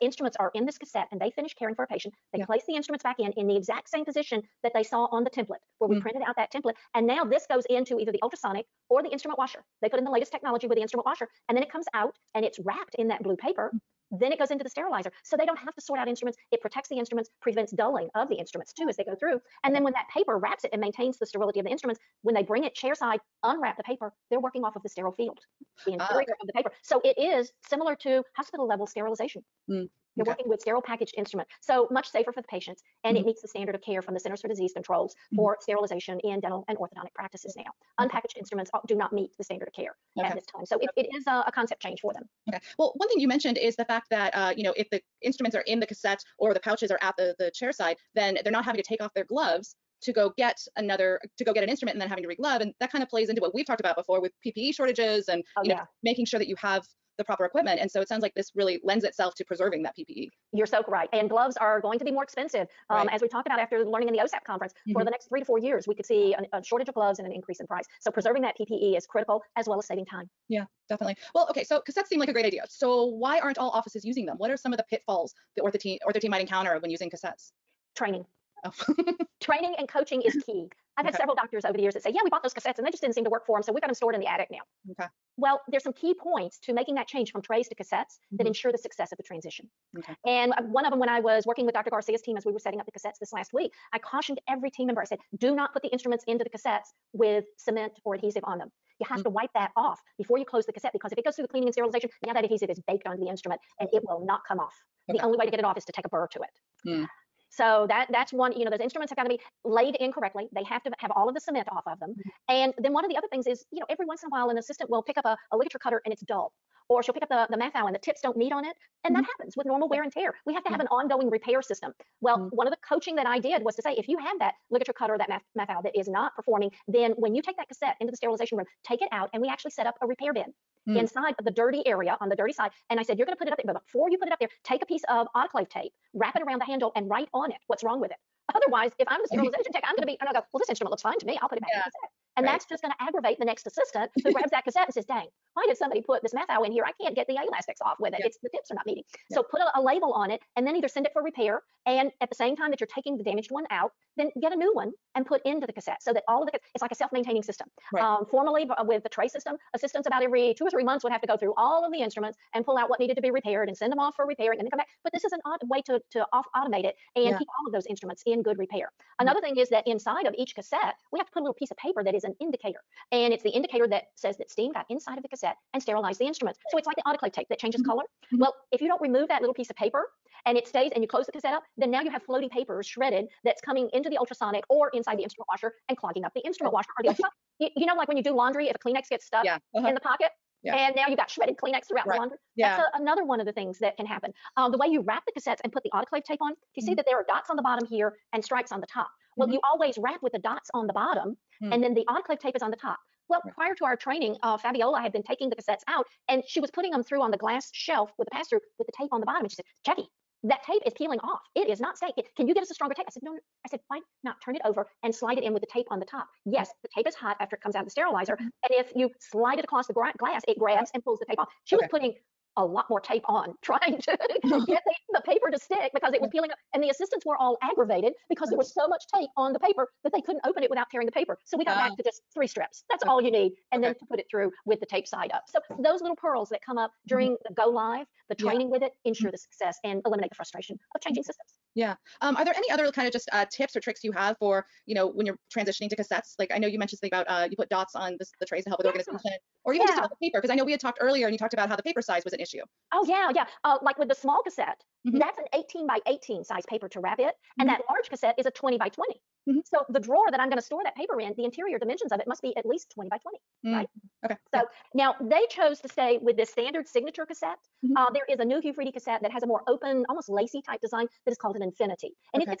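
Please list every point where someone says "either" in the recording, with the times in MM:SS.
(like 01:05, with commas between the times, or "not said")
00:07, 02:30.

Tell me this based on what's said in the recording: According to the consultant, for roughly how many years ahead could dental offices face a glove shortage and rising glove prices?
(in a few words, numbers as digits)
3 to 4 years.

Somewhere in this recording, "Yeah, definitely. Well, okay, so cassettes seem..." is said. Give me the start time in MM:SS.
01:10.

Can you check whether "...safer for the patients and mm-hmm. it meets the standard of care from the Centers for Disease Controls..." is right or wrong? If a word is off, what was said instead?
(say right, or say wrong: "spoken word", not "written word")
right.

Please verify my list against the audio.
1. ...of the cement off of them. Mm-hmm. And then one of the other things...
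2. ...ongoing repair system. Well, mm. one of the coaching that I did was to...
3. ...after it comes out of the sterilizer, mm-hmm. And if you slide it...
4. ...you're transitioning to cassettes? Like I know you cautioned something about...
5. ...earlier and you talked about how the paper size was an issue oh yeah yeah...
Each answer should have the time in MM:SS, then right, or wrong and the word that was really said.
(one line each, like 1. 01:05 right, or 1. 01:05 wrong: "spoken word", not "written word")
1. 01:51 right
2. 02:00 right
3. 03:37 right
4. 04:05 wrong: "mentioned", not "cautioned"
5. 04:10 right.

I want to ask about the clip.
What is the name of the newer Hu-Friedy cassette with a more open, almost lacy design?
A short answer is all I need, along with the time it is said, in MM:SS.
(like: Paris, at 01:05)
Infinity, at 04:31.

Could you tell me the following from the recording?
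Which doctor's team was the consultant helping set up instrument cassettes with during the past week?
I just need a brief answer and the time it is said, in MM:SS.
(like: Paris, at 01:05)
Dr. Garcia, at 01:31.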